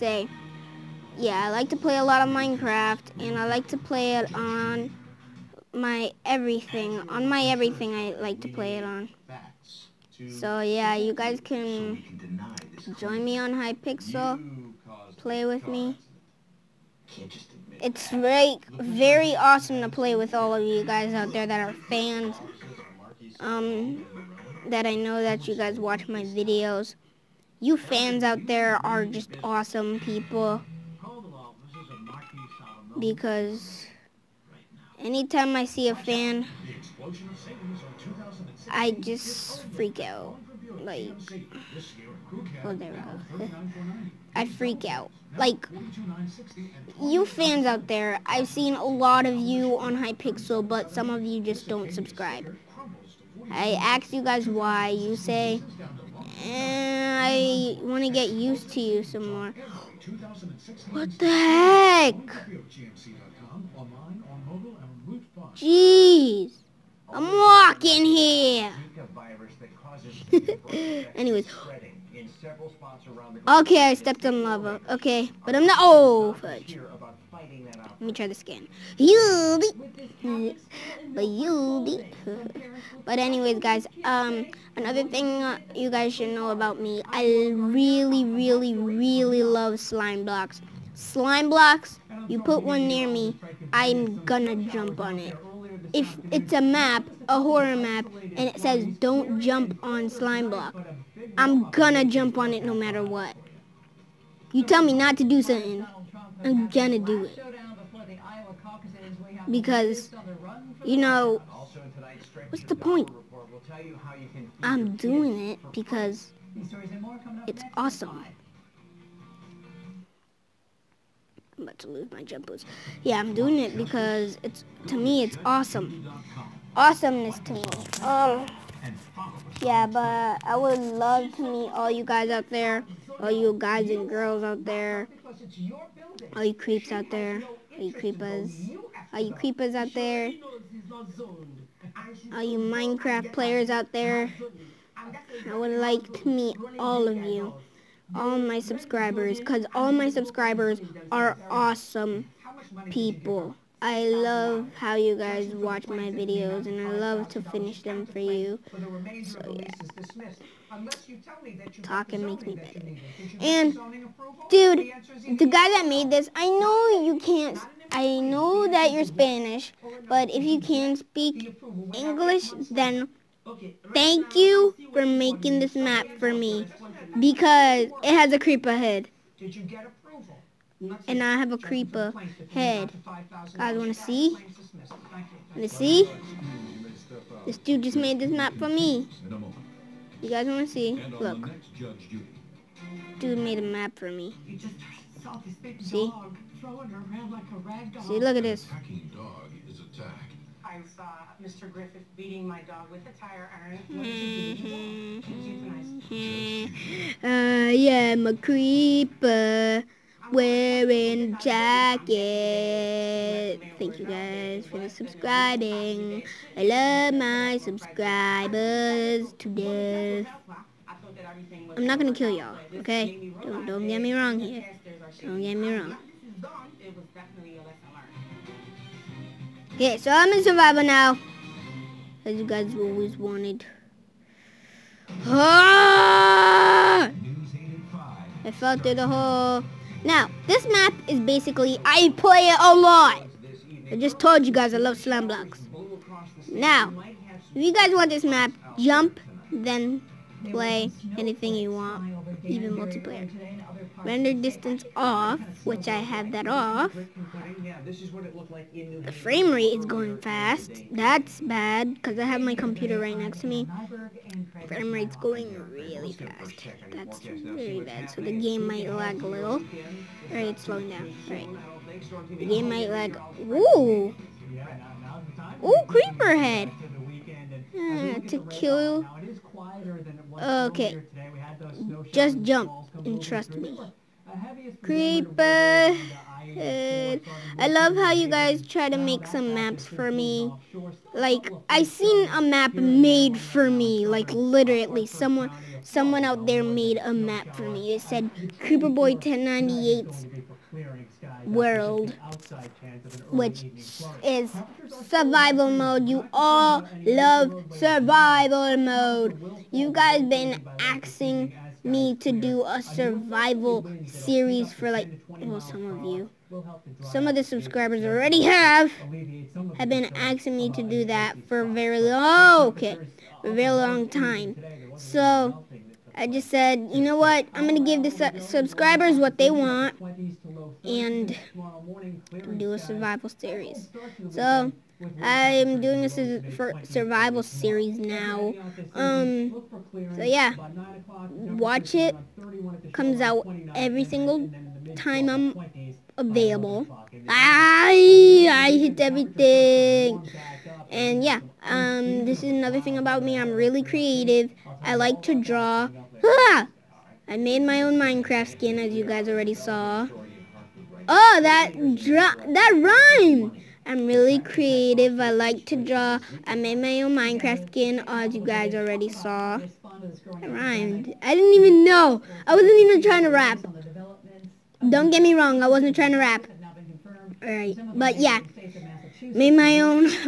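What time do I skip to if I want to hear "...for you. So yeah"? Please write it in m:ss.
2:38.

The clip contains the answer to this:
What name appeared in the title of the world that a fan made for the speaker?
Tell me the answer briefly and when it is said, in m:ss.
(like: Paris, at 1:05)
Creeper Boy 1098, at 4:58.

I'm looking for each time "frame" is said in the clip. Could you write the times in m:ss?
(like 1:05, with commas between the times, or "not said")
4:19, 4:24.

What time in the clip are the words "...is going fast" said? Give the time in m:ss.
4:19.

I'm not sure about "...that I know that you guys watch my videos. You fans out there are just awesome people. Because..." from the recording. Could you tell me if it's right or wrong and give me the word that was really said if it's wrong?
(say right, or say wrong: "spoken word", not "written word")
right.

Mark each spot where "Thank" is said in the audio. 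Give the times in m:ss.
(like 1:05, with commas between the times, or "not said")
2:53, 3:33.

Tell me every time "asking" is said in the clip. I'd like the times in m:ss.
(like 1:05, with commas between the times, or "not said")
5:10, 5:20.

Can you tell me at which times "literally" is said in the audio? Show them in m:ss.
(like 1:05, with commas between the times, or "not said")
4:54.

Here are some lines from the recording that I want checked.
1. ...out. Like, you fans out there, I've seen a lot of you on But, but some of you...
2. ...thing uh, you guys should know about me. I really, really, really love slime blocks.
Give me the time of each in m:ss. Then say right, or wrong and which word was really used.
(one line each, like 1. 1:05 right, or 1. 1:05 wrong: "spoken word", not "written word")
1. 0:44 wrong: "Hypixel", not "But"
2. 1:25 right.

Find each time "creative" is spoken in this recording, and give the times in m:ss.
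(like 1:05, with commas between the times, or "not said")
5:53, 6:04.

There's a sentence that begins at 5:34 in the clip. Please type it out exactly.
So, I'm doing a su survival series now.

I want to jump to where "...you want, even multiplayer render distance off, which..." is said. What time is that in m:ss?
4:11.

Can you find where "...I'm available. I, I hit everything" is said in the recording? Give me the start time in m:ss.
5:45.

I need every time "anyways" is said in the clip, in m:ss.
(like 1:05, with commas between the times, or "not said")
1:11, 1:23.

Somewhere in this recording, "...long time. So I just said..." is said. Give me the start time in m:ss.
5:23.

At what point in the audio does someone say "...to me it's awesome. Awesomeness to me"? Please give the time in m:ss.
2:04.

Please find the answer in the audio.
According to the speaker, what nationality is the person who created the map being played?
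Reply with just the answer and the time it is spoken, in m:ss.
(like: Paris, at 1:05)
Spanish, at 2:49.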